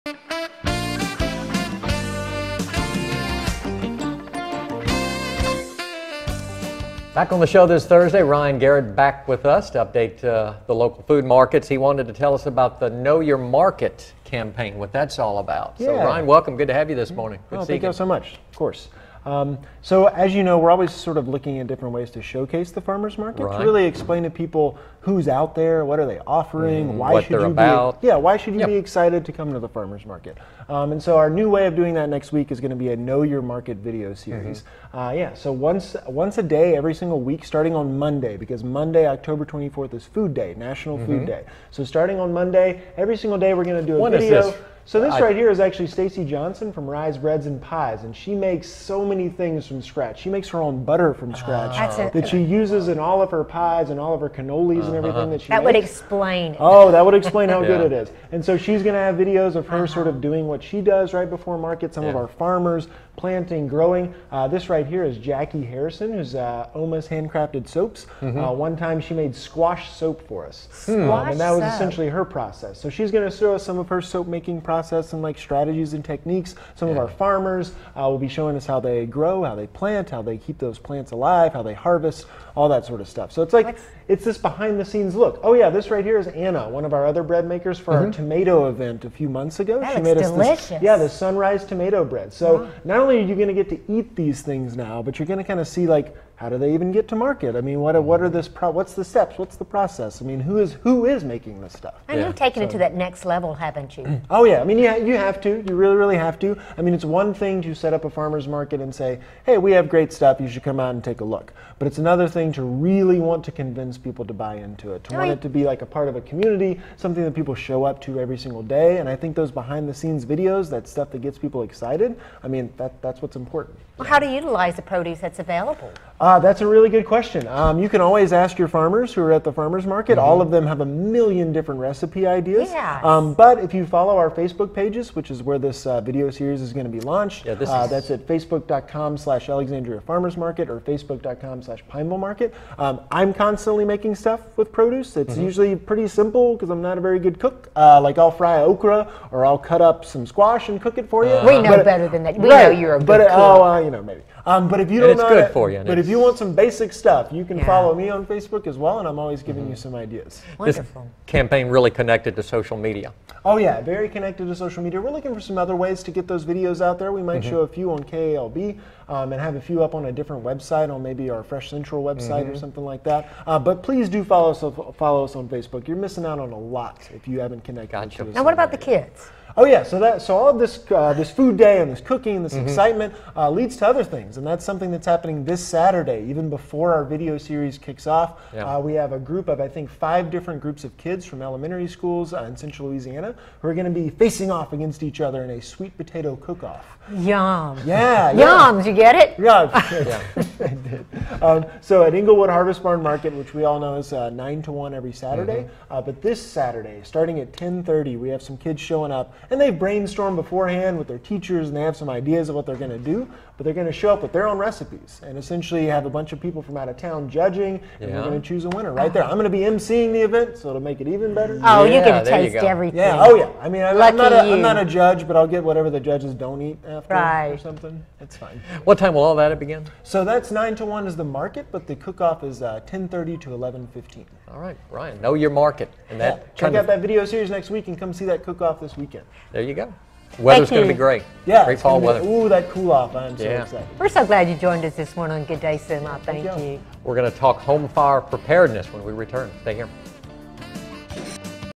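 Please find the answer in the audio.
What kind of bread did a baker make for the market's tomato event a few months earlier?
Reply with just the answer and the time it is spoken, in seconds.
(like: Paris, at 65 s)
Sunrise tomato bread, at 91 s.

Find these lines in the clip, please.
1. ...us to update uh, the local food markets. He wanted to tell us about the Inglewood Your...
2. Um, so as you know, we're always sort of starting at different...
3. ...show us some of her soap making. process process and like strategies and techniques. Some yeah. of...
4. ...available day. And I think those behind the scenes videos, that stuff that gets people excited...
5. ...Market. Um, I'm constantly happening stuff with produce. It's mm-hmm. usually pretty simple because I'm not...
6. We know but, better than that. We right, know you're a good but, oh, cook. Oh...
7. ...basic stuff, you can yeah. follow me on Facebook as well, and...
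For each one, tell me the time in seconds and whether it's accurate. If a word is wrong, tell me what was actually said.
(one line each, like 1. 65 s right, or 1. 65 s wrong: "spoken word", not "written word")
1. 9 s wrong: "Know", not "Inglewood"
2. 19 s wrong: "looking", not "starting"
3. 73 s right
4. 118 s wrong: "single", not "available"
5. 142 s wrong: "making", not "happening"
6. 151 s right
7. 156 s right.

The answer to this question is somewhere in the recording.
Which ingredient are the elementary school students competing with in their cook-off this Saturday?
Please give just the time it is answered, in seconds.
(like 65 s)
195 s.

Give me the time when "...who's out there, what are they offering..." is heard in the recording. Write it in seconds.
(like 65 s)
25 s.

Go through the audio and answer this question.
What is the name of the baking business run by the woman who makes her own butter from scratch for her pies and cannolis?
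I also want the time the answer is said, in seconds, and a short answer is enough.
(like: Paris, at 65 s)
Rise Breads and Pies, at 46 s.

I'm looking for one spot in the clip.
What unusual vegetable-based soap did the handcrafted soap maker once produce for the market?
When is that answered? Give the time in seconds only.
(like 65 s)
69 s.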